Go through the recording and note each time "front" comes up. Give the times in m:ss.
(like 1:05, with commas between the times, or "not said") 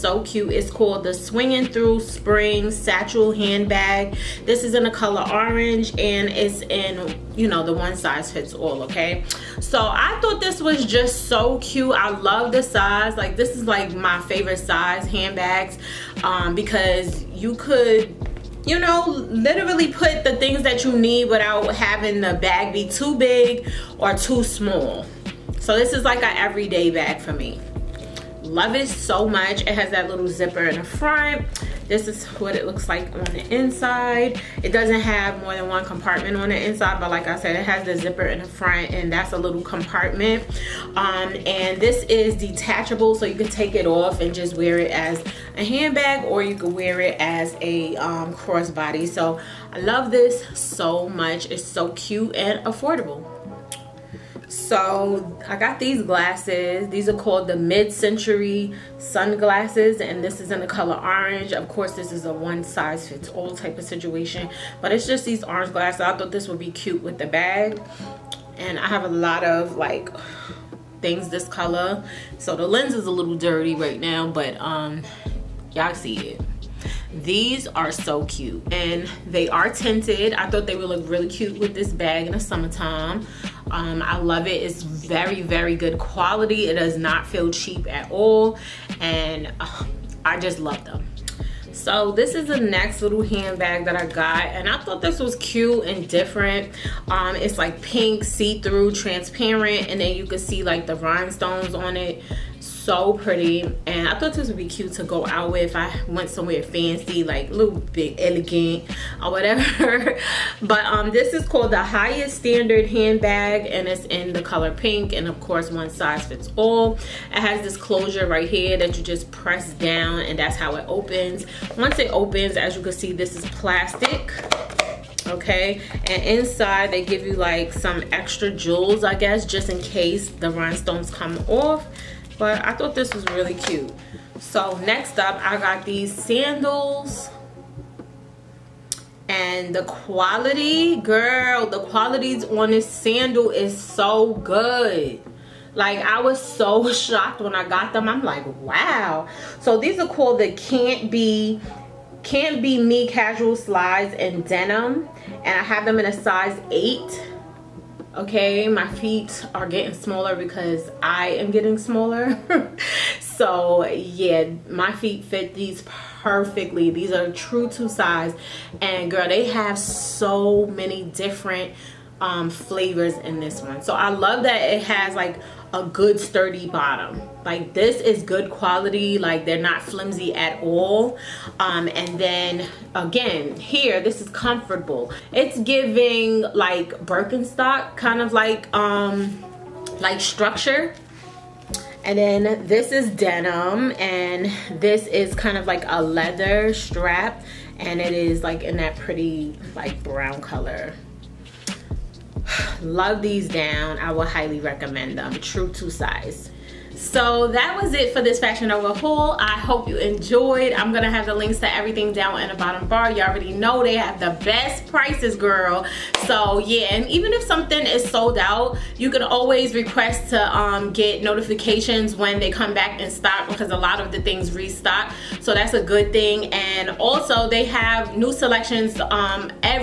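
0:30, 0:38.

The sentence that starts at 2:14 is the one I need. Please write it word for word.
So next up, I got these sandals.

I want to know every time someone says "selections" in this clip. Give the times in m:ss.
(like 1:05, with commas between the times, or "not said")
3:48.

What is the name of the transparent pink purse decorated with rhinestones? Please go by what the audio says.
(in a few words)
Highest Standard handbag.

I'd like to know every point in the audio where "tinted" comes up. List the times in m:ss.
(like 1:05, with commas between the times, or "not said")
1:19.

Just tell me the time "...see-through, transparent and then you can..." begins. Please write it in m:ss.
1:38.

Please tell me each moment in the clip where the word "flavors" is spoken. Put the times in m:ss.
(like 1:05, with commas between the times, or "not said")
2:52.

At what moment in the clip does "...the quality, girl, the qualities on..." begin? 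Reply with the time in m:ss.
2:19.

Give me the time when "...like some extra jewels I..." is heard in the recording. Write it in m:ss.
2:07.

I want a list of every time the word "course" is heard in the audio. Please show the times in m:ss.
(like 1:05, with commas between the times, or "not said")
1:01, 1:55.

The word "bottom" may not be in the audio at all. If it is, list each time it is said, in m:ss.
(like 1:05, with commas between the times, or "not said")
2:56, 3:32.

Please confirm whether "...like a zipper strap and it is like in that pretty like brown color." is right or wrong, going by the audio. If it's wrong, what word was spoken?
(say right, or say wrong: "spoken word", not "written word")
wrong: "leather", not "zipper".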